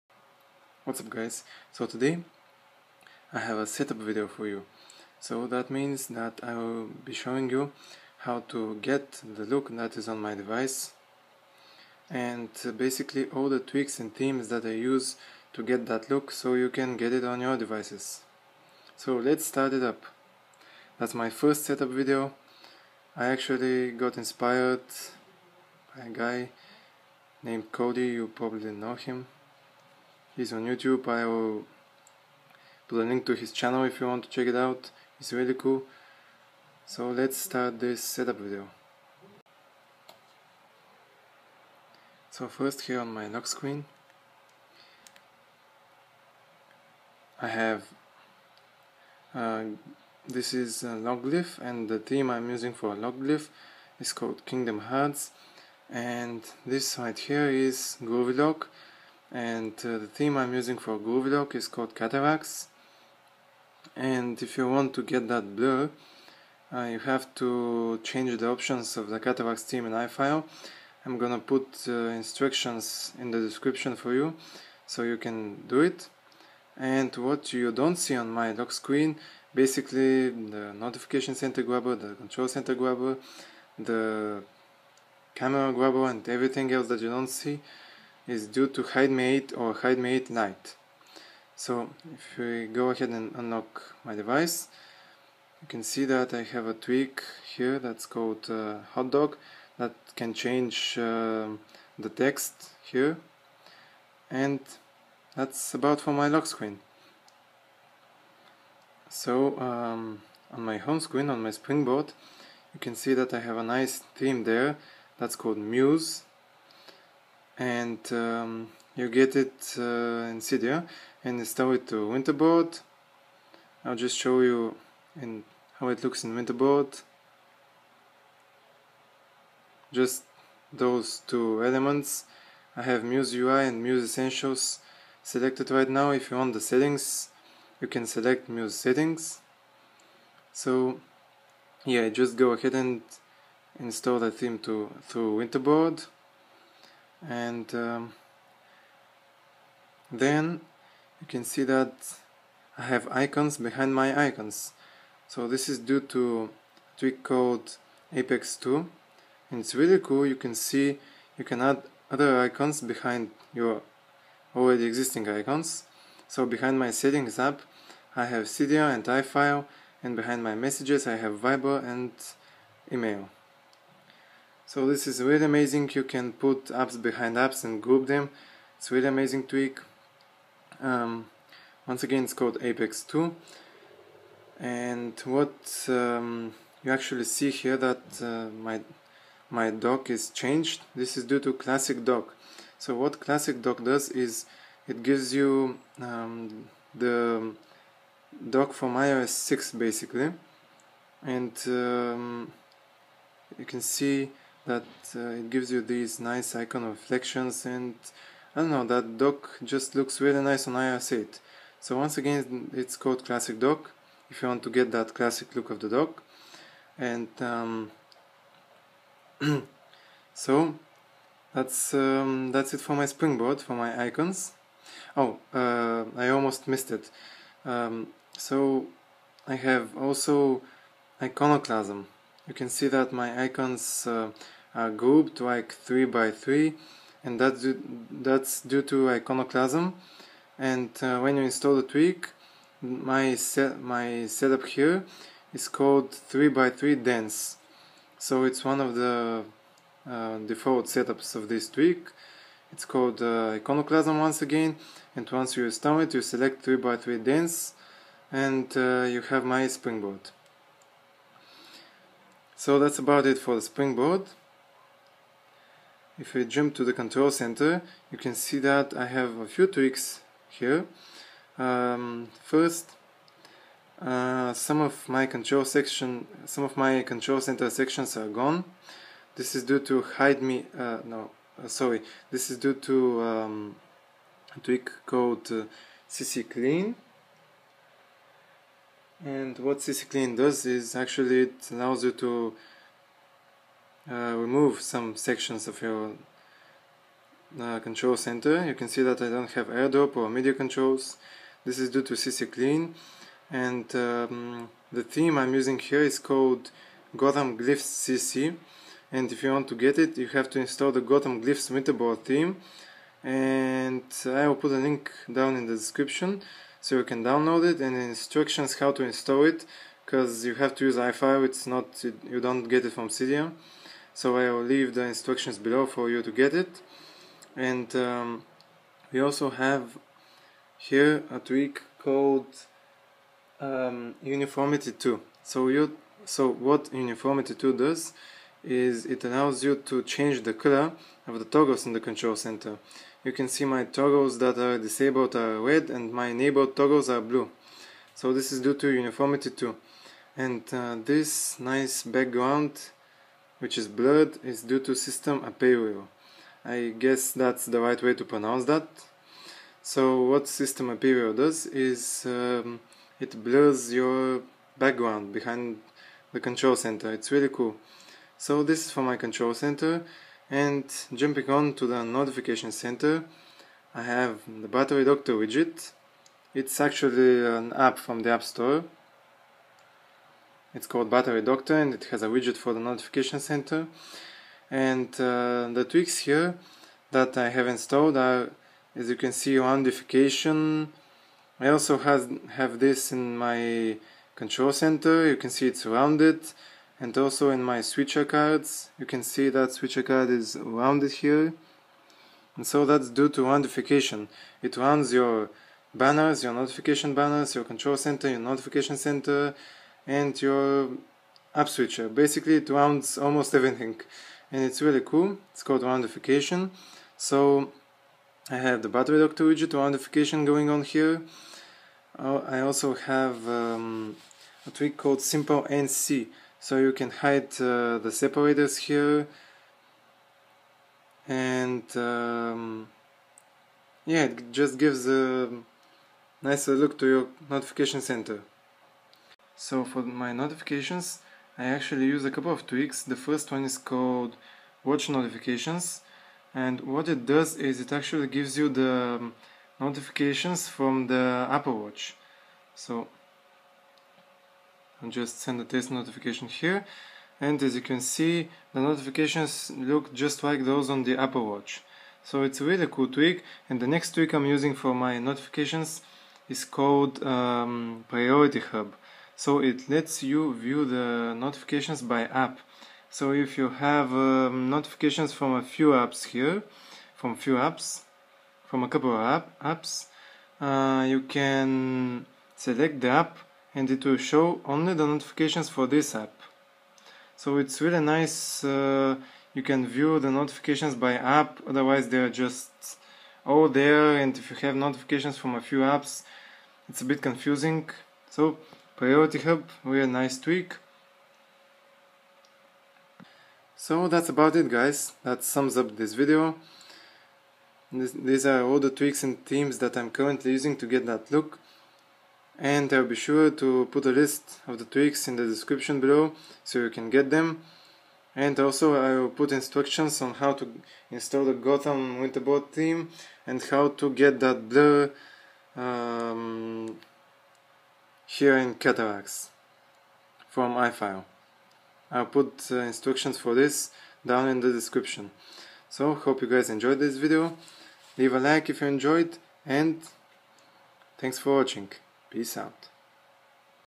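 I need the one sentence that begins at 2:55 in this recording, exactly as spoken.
You can put apps behind apps and group them.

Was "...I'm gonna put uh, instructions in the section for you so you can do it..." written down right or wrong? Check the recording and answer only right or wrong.
wrong.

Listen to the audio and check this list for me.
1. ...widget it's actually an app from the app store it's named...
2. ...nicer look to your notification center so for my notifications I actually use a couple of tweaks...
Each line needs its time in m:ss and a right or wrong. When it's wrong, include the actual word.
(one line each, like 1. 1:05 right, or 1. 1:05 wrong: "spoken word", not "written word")
1. 6:15 wrong: "called", not "named"
2. 7:16 right.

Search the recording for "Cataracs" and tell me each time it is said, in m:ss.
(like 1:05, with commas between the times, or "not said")
1:01, 1:09, 8:48.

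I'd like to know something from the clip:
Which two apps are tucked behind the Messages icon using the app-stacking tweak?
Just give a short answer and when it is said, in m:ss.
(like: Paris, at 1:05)
Viber and email, at 2:51.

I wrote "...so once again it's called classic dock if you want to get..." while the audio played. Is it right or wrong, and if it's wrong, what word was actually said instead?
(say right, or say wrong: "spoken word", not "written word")
right.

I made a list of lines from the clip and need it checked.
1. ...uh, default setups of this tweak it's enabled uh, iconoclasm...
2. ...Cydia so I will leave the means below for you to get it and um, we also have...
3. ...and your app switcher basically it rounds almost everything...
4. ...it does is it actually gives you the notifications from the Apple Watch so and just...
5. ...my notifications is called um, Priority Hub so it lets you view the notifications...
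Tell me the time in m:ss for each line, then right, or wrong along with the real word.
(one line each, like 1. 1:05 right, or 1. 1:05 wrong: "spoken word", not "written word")
1. 4:10 wrong: "called", not "enabled"
2. 5:23 wrong: "instructions", not "means"
3. 6:50 right
4. 7:27 right
5. 7:44 right.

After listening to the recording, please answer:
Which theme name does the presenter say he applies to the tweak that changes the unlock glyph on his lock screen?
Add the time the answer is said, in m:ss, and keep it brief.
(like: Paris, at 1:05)
Kingdom Hearts, at 0:54.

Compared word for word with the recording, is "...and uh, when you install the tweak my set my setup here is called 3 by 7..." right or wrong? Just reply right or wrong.
wrong.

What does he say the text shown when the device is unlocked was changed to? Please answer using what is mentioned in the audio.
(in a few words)
hot dog.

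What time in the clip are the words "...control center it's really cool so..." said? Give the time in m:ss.
6:06.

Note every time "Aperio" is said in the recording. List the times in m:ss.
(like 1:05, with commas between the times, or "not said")
5:55, 6:00.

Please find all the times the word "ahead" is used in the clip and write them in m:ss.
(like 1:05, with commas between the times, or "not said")
1:32, 2:22.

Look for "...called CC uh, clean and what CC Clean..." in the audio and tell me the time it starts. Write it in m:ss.
4:45.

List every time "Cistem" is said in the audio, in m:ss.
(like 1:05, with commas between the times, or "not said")
5:54, 6:00.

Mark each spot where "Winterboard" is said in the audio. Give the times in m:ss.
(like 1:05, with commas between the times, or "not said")
2:02, 2:06, 2:25, 5:11, 8:42.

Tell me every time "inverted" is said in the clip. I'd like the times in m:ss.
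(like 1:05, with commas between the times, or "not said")
not said.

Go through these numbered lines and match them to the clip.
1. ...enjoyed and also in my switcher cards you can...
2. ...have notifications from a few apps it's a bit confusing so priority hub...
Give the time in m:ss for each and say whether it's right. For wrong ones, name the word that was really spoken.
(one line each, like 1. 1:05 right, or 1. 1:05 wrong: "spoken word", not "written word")
1. 6:35 wrong: "rounded", not "enjoyed"
2. 8:14 right.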